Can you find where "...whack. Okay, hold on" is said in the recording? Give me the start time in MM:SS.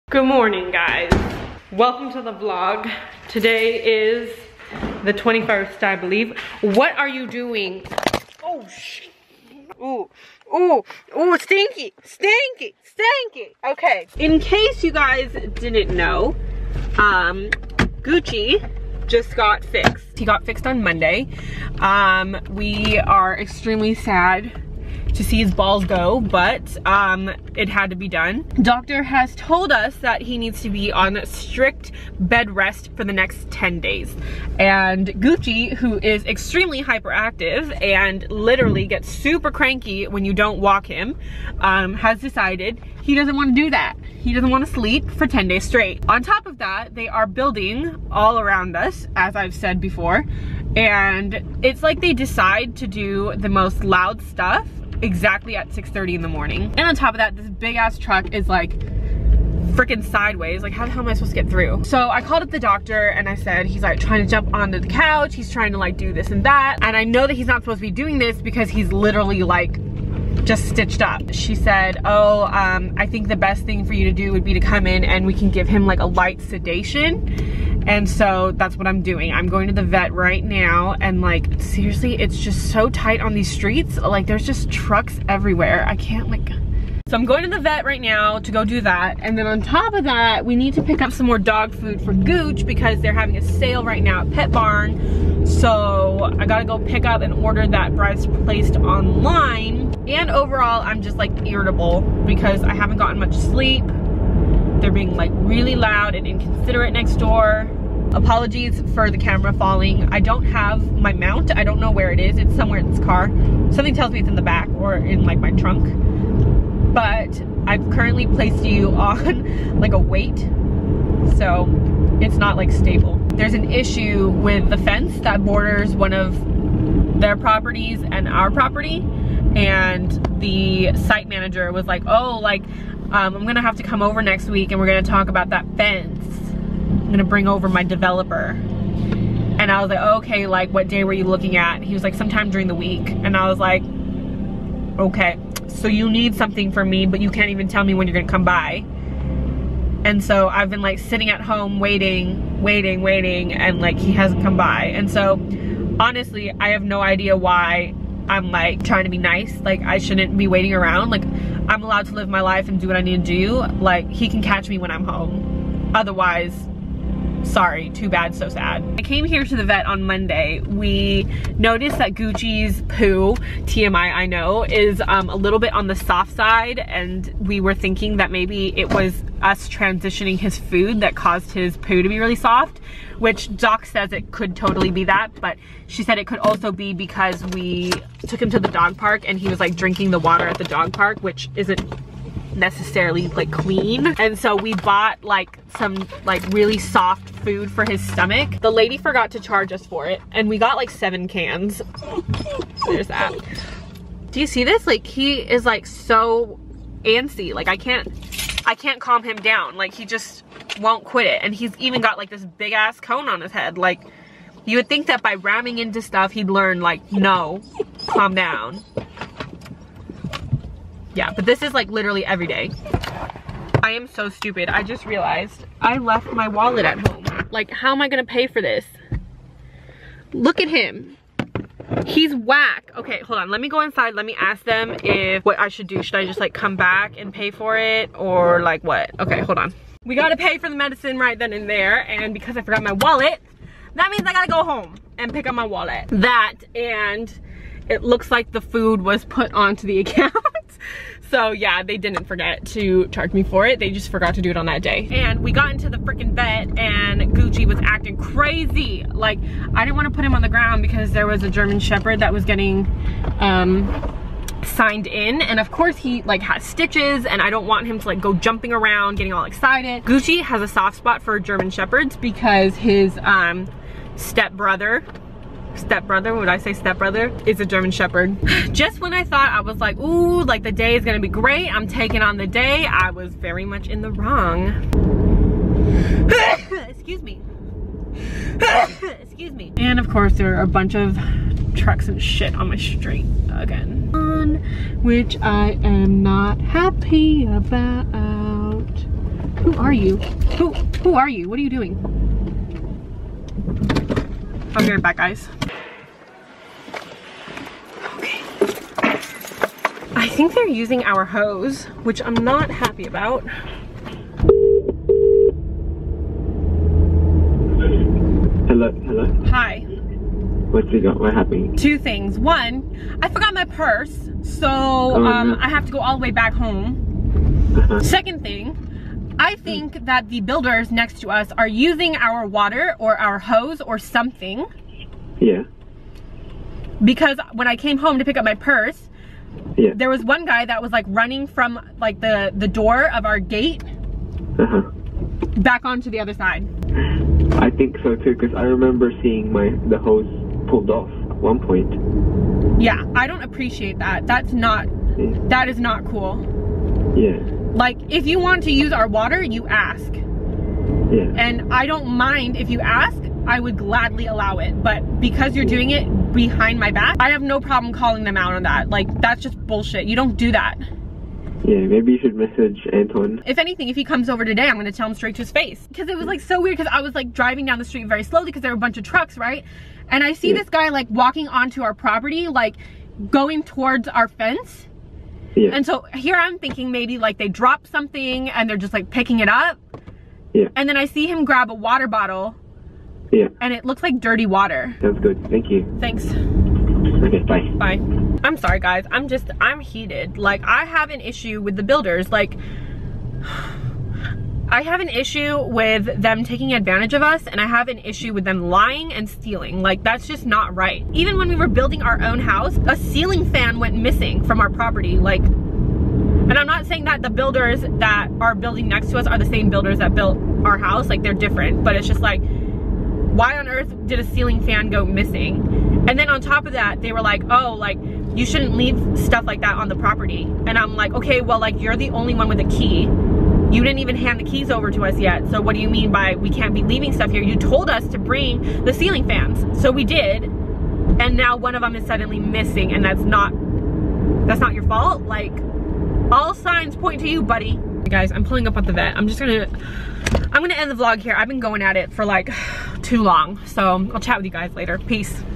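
03:52.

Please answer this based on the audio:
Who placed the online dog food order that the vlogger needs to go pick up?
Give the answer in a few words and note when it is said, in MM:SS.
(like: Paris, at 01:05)
Bryce, at 01:37.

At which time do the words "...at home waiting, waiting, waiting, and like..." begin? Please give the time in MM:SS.
02:31.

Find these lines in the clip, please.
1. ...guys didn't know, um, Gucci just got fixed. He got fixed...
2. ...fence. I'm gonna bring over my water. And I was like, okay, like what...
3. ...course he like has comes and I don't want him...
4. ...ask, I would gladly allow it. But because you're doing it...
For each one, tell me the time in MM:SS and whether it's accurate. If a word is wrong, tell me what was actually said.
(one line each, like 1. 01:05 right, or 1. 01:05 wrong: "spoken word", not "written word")
1. 00:14 right
2. 02:15 wrong: "developer", not "water"
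3. 04:25 wrong: "stitches", not "comes"
4. 06:02 right.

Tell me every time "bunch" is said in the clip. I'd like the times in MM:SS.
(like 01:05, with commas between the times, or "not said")
04:50, 06:18.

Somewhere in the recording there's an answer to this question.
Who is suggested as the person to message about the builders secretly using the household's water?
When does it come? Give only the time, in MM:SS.
06:12.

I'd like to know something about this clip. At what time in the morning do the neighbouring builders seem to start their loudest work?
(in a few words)
6:30.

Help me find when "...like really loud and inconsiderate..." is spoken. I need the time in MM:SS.
01:45.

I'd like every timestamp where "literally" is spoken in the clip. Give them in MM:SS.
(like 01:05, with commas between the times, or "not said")
00:38, 01:08, 03:41.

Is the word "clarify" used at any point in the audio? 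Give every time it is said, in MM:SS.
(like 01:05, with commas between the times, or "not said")
not said.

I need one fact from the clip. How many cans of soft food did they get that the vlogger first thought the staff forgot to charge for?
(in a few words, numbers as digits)
7.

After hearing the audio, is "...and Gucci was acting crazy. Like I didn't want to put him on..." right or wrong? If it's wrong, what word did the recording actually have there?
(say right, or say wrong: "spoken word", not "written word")
right.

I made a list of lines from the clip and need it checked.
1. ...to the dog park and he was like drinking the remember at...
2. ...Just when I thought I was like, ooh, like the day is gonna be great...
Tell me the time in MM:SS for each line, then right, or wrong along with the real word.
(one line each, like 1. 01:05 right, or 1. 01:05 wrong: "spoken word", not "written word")
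1. 03:08 wrong: "water", not "remember"
2. 04:38 right.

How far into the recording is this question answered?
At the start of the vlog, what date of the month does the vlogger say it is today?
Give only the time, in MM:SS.
00:05.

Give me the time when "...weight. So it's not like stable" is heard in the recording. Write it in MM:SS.
01:59.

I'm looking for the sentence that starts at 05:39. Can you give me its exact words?
there was one guy that was like running from like the, the door of our gate uh-huh.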